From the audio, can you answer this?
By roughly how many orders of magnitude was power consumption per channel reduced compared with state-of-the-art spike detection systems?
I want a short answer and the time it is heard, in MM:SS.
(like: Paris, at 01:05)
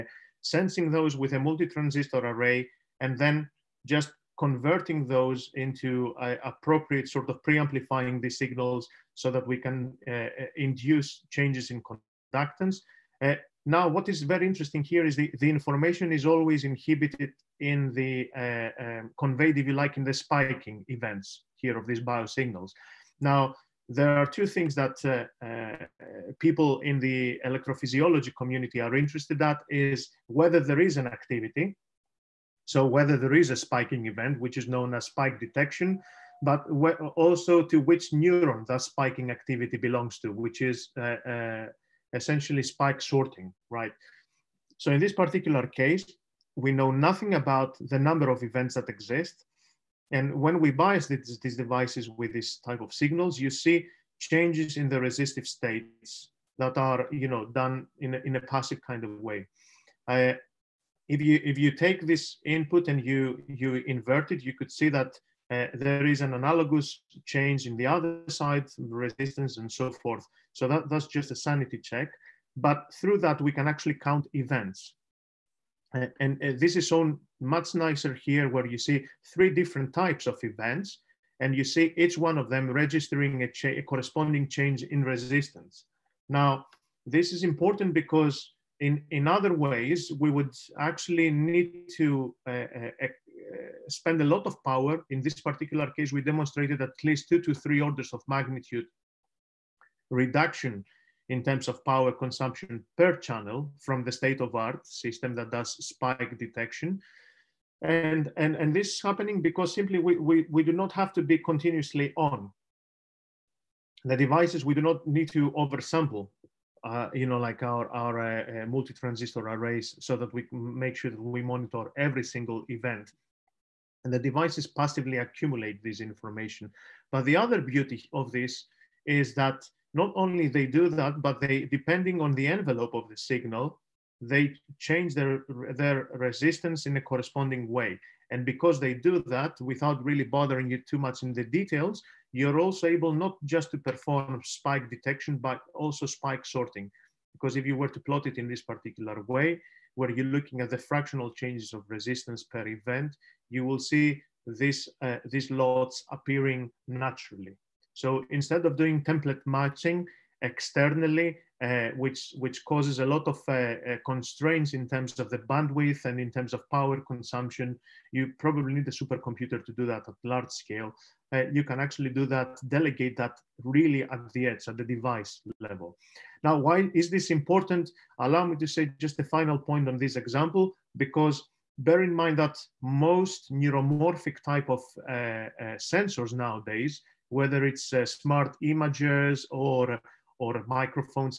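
2 to 3, at 01:37.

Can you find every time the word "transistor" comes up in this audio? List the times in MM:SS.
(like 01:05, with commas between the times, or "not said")
00:01, 01:58.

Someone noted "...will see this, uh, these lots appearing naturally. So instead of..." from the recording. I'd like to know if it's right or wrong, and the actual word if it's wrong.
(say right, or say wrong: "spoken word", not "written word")
right.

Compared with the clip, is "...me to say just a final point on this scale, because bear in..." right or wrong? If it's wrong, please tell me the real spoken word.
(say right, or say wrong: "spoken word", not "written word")
wrong: "example", not "scale".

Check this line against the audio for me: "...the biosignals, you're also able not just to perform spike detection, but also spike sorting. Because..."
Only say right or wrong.
wrong.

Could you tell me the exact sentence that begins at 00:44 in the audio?
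So in this particular case, we know nothing about the number of events that exist.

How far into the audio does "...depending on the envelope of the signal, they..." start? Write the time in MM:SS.
02:11.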